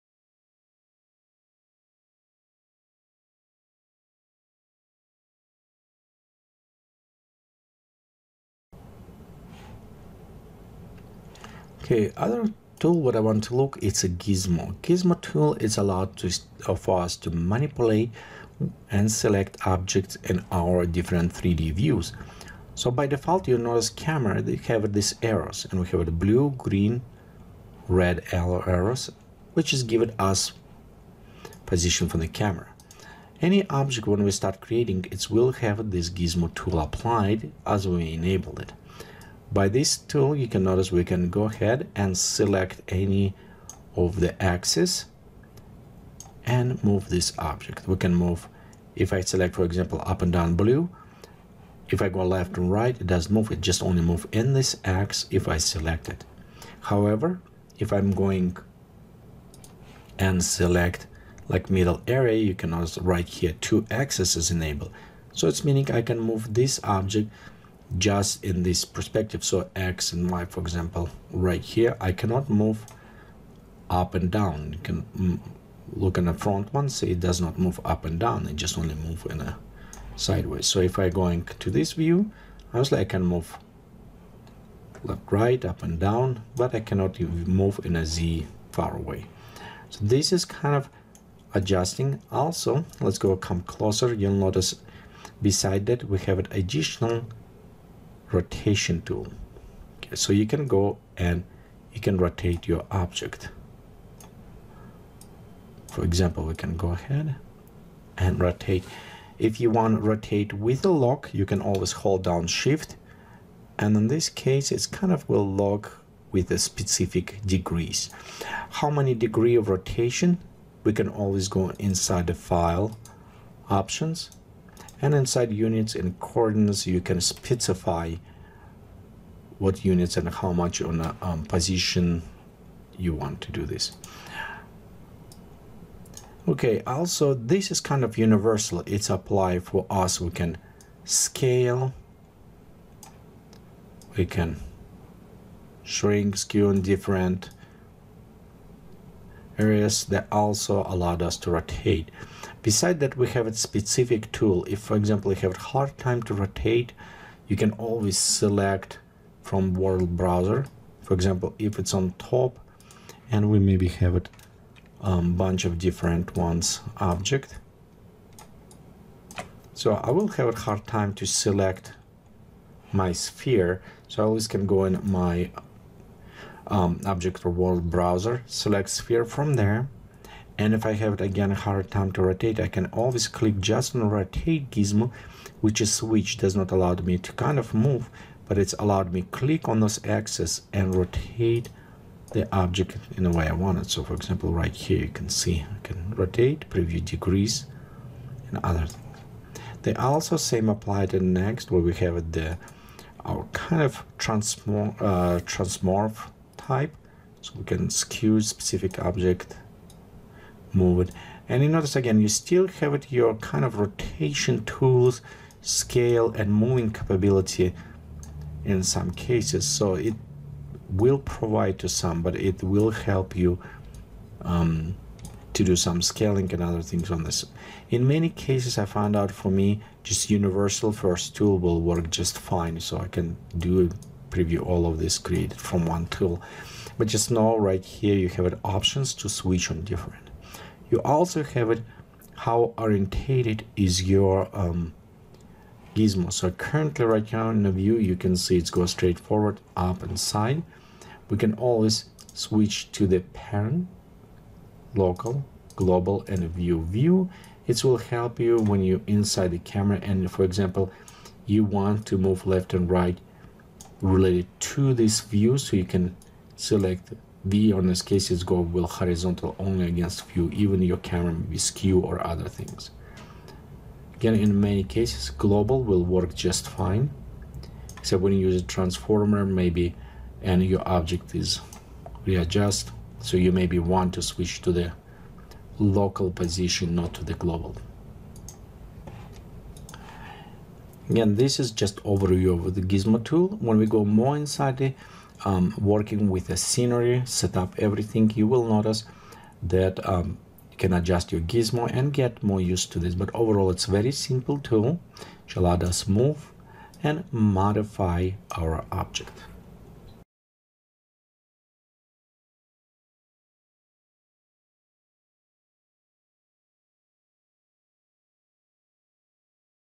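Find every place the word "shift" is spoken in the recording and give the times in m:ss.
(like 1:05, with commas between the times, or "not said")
1:52.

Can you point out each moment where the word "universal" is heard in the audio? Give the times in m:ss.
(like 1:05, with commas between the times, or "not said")
2:18, 3:50.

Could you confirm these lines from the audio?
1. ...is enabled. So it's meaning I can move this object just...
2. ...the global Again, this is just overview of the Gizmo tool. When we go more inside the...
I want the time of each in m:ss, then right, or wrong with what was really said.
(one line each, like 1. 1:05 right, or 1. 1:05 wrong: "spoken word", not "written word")
1. 1:04 right
2. 4:47 right.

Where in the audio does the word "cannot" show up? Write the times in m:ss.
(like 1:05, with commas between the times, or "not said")
1:12, 1:26.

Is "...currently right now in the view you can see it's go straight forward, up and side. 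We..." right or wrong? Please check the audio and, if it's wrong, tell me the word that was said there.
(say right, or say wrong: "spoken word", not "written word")
right.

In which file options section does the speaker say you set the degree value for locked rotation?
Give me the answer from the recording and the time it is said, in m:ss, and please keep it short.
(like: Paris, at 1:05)
Units and coordinates, at 2:05.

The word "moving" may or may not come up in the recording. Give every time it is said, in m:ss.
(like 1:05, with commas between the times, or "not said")
3:36.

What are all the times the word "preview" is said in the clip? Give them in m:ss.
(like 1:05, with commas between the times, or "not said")
3:16, 3:54.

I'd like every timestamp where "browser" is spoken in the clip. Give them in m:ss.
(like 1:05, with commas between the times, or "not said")
2:40, 2:57.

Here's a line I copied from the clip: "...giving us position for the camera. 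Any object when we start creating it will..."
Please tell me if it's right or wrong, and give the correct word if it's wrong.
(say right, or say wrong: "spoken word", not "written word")
right.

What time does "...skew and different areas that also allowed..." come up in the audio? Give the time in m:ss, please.
2:26.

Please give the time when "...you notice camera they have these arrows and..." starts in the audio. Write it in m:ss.
0:23.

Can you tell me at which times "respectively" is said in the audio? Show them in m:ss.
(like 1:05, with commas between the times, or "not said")
not said.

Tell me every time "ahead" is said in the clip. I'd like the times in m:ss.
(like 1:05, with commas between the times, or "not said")
0:41, 1:46.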